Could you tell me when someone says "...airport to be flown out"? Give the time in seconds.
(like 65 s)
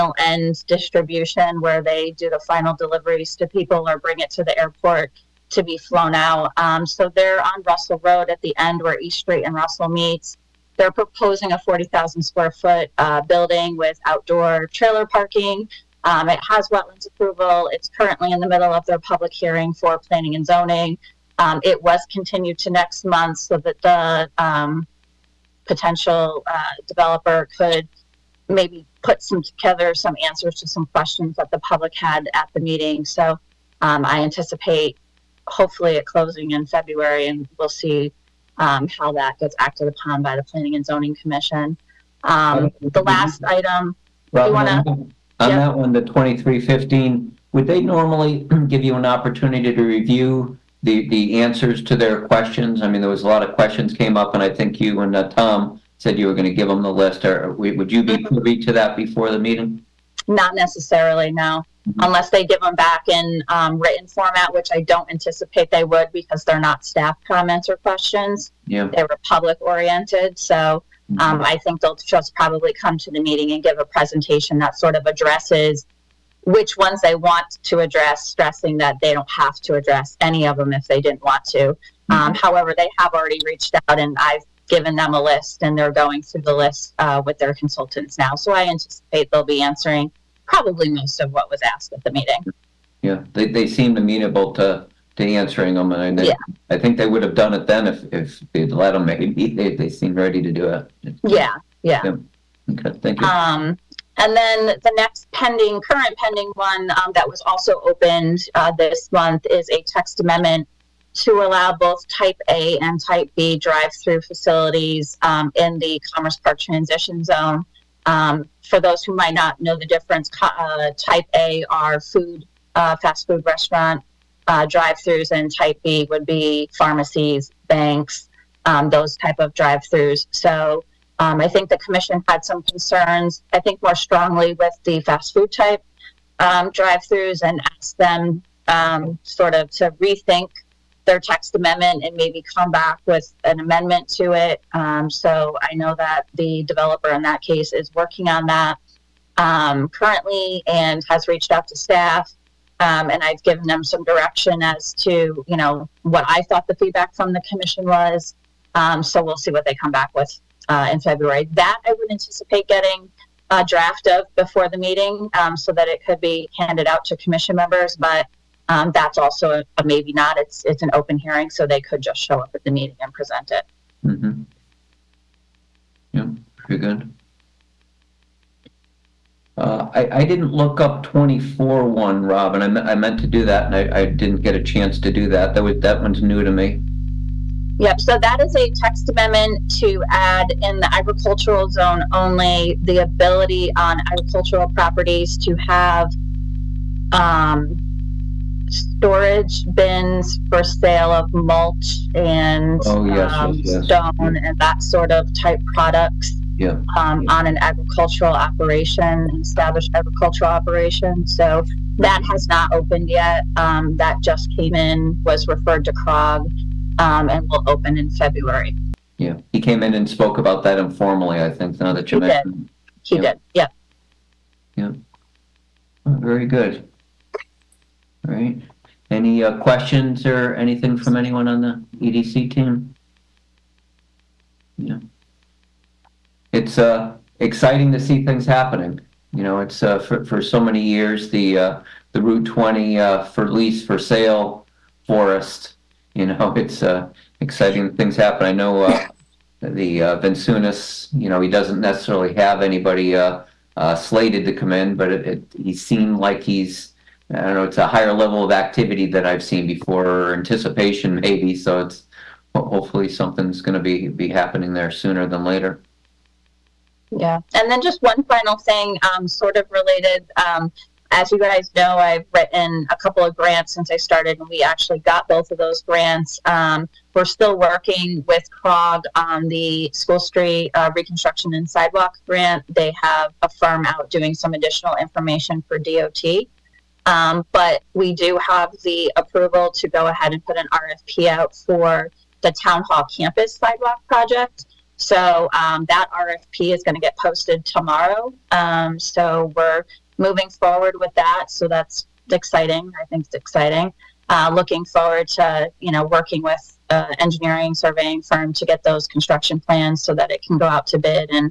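4 s.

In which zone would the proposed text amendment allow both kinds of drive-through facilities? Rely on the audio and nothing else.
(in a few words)
Commerce Park transition zone.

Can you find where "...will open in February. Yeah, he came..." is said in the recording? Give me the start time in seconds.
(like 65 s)
217 s.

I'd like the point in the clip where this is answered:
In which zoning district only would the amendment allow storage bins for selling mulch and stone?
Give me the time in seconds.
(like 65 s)
190 s.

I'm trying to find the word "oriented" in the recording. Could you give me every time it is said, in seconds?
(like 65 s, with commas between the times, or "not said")
69 s.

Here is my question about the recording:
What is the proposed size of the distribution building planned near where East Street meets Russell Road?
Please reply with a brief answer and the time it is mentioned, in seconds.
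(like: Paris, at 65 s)
40,000 square feet, at 11 s.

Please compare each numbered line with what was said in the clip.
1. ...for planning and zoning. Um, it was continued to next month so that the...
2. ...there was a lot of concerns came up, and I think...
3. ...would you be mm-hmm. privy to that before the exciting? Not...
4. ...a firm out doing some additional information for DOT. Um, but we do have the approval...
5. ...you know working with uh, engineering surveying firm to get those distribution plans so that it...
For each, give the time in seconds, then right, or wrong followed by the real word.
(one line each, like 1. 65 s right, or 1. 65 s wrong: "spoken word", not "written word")
1. 19 s right
2. 53 s wrong: "questions", not "concerns"
3. 57 s wrong: "meeting", not "exciting"
4. 283 s right
5. 305 s wrong: "construction", not "distribution".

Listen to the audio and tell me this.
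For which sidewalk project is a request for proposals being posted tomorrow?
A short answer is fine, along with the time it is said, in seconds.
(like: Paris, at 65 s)
Town Hall Campus Sidewalk Project, at 292 s.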